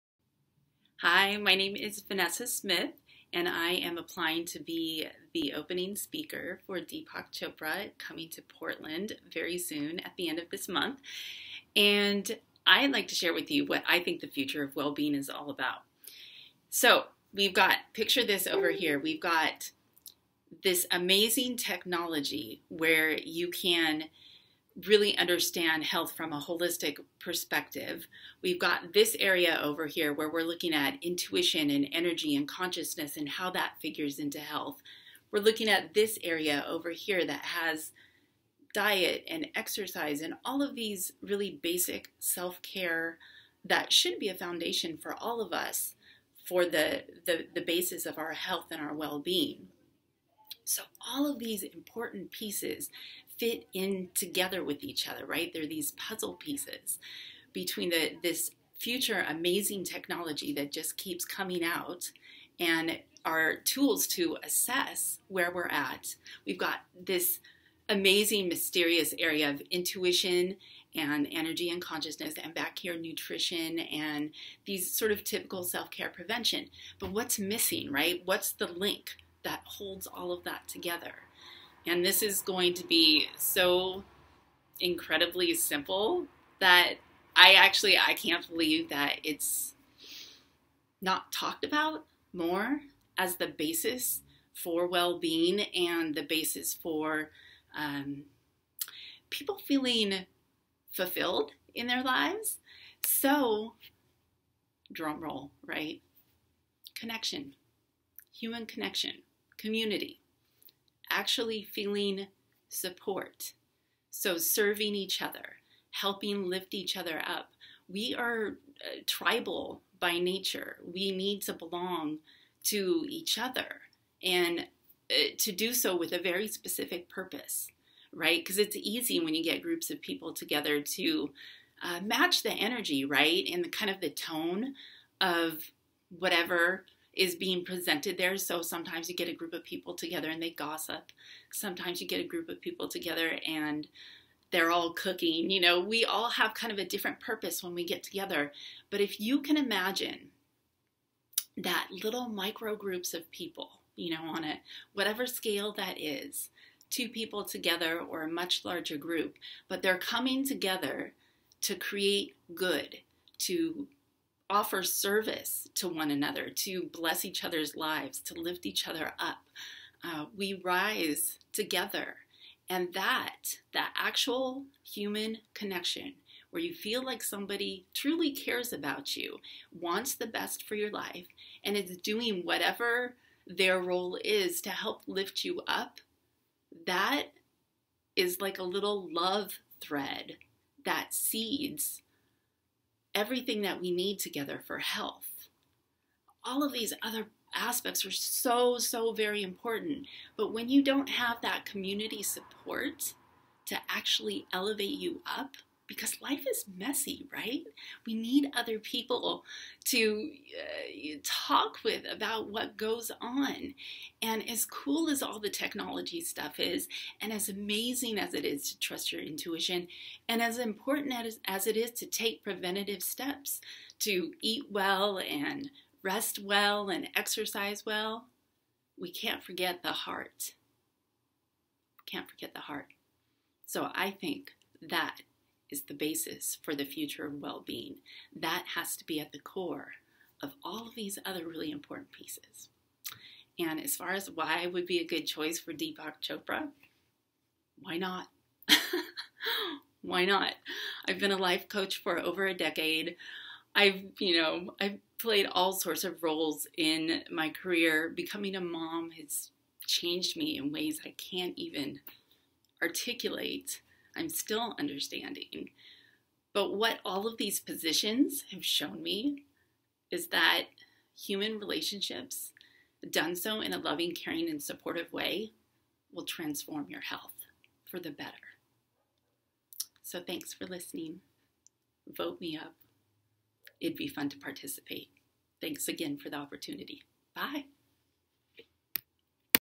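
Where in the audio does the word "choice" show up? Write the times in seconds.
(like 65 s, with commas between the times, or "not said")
245 s.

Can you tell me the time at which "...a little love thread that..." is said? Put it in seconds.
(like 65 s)
188 s.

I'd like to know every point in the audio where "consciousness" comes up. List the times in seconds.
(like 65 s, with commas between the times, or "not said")
32 s, 71 s.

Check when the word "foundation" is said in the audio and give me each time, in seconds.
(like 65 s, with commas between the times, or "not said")
44 s.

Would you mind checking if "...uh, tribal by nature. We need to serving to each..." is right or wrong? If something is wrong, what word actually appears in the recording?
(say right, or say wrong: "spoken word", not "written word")
wrong: "belong", not "serving".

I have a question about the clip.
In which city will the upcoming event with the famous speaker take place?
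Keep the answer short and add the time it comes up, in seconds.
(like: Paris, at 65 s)
Portland, at 8 s.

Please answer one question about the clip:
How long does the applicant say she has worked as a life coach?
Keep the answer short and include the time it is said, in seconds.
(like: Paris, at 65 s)
Over a decade, at 252 s.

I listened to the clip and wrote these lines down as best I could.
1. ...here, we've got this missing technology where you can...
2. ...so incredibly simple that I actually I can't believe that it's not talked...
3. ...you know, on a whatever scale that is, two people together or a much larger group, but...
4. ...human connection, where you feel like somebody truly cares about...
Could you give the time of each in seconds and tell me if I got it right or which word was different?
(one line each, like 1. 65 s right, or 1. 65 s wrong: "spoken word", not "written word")
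1. 18 s wrong: "amazing", not "missing"
2. 83 s right
3. 153 s right
4. 174 s right.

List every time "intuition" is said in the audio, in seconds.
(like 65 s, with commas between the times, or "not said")
31 s, 69 s, 219 s.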